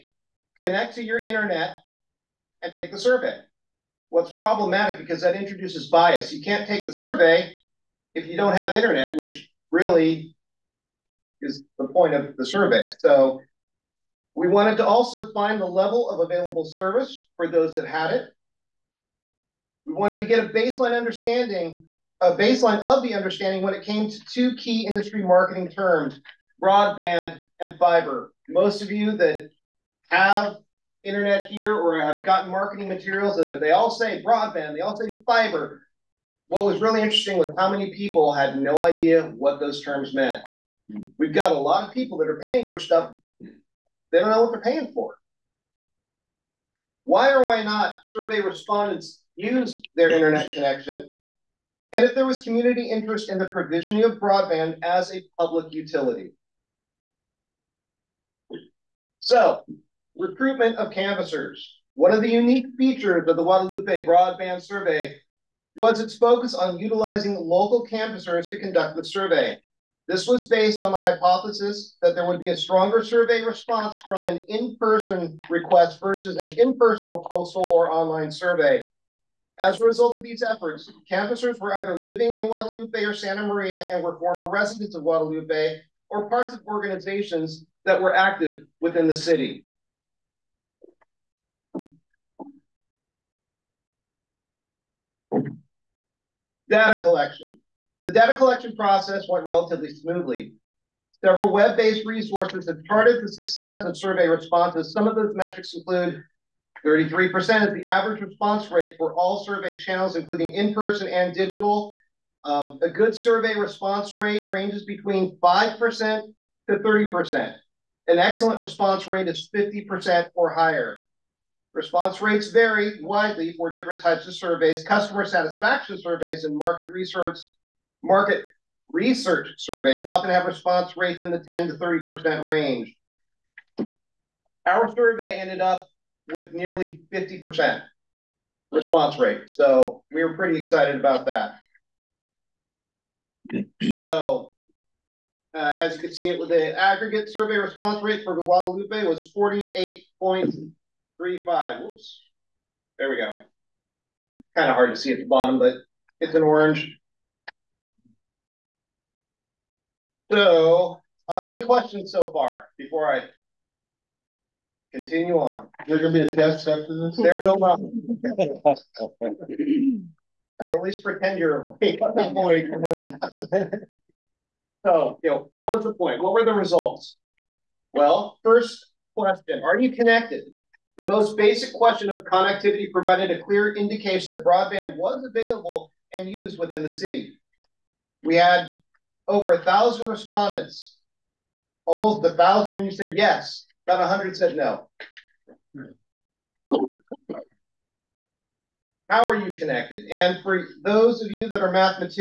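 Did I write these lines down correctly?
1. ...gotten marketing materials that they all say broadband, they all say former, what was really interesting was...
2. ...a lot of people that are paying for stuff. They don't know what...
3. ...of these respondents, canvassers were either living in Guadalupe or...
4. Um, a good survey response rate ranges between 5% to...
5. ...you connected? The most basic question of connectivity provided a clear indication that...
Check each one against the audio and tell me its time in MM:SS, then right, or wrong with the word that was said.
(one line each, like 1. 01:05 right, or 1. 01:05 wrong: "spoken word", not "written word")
1. 00:32 wrong: "fiber", not "former"
2. 00:41 right
3. 01:20 wrong: "efforts", not "respondents"
4. 01:52 right
5. 02:59 right.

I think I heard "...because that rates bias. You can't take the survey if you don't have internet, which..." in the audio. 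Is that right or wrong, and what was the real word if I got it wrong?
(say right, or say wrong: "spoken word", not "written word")
wrong: "introduces", not "rates".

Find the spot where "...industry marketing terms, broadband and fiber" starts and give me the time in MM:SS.
00:24.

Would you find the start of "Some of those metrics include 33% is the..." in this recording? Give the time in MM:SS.
01:44.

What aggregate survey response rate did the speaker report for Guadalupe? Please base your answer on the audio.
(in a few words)
48.35%.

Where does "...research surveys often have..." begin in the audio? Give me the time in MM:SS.
02:08.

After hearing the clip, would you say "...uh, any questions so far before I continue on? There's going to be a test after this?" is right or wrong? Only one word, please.
right.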